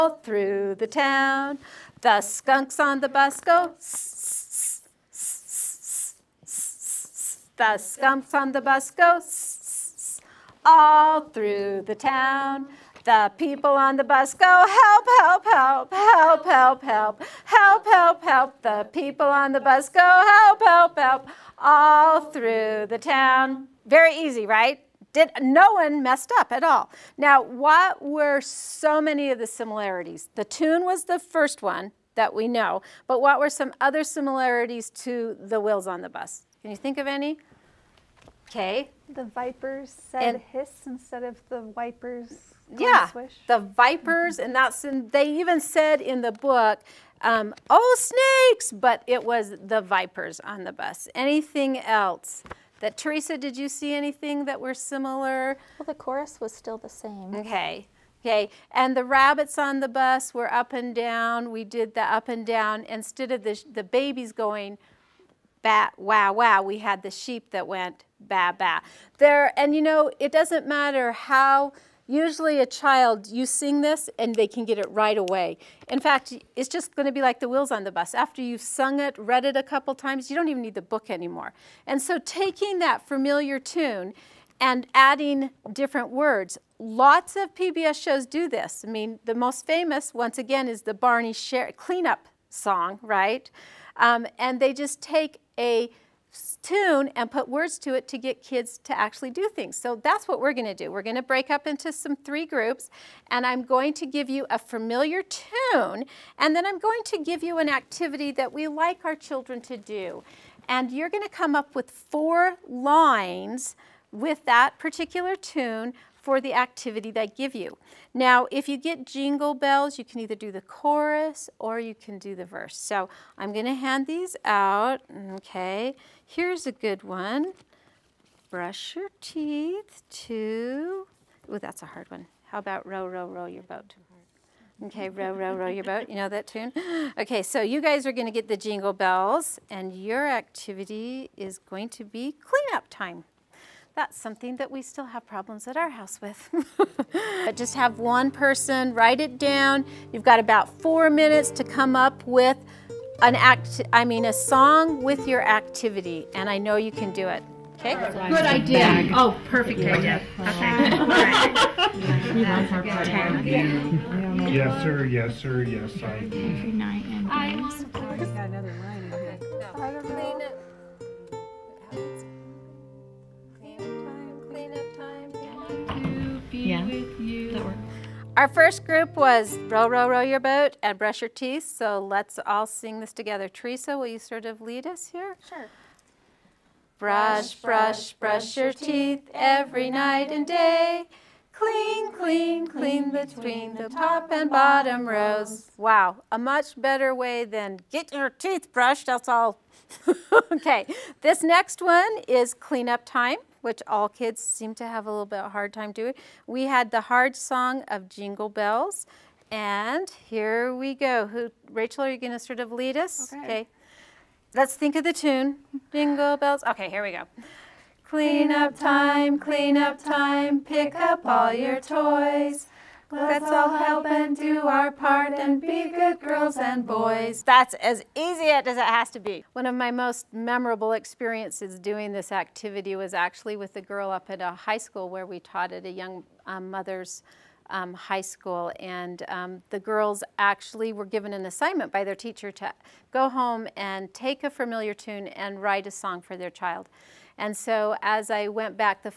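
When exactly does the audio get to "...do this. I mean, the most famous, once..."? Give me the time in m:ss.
1:28.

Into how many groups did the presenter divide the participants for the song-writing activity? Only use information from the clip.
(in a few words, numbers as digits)
3.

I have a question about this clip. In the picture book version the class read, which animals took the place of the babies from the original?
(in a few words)
sheep.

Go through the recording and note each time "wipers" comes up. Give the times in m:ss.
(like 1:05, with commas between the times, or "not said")
0:41.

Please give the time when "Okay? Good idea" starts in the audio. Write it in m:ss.
2:37.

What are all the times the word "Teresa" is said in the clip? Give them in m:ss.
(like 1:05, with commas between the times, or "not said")
0:52, 3:03.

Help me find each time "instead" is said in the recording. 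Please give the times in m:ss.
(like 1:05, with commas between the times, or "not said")
0:40, 1:02.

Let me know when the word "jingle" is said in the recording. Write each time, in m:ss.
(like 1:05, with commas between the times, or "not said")
1:59, 2:18, 3:28, 3:35.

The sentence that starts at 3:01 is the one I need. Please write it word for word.
So let's all sing this together.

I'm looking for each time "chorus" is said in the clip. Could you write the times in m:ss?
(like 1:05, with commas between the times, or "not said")
0:56, 2:00.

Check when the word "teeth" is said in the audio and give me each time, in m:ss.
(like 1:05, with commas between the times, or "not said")
2:09, 3:01, 3:08, 3:18.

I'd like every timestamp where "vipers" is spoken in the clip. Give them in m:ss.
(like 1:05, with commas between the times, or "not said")
0:39, 0:43, 0:49.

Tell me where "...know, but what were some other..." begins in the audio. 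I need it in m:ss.
0:32.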